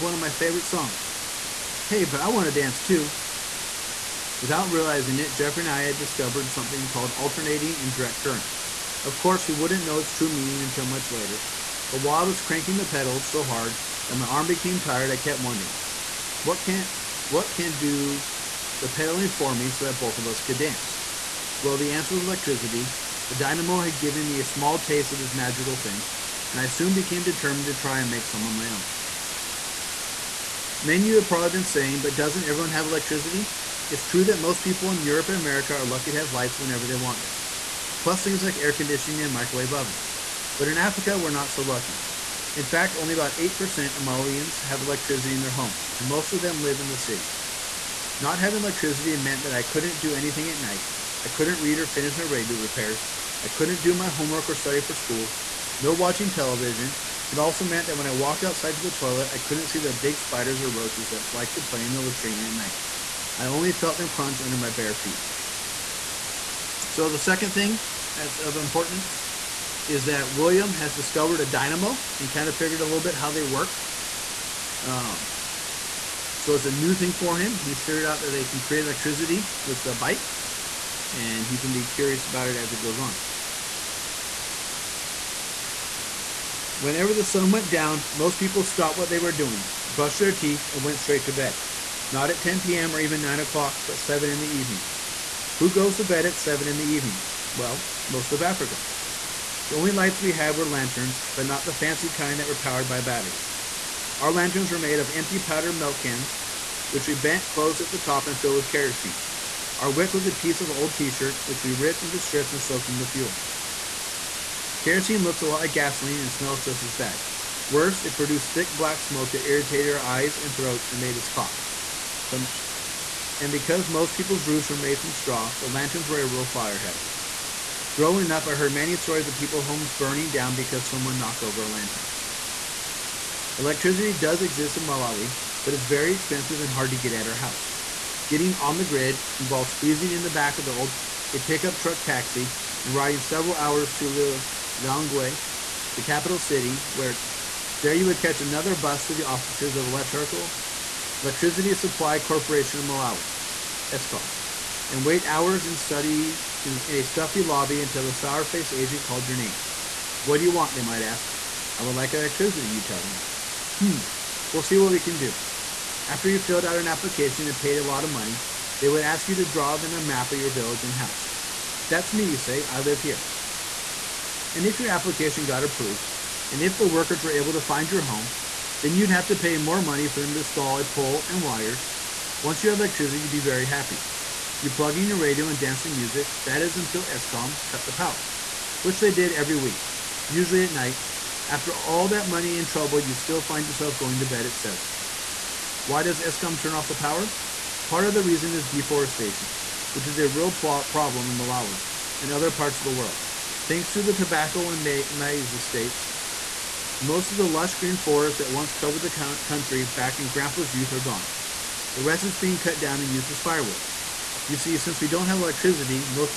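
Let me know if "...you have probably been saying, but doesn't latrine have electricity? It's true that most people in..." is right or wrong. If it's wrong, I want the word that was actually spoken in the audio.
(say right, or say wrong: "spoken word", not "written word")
wrong: "everyone", not "latrine".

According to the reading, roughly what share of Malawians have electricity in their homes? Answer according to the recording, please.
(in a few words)
8%.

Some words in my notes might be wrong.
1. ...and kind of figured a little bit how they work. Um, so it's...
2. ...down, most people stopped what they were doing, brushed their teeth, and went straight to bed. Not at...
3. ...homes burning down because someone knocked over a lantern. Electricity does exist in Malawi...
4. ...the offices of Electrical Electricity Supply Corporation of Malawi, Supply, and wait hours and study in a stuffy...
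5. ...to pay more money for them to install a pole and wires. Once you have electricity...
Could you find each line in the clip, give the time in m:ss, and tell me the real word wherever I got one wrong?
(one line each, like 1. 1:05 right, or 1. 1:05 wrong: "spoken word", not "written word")
1. 1:12 right
2. 1:27 right
3. 2:09 right
4. 2:29 wrong: "ESCOM", not "Supply"
5. 2:59 right.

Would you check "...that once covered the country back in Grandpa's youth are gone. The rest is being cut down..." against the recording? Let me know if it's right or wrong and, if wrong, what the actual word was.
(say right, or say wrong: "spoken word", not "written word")
right.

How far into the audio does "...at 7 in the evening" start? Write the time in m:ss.
1:36.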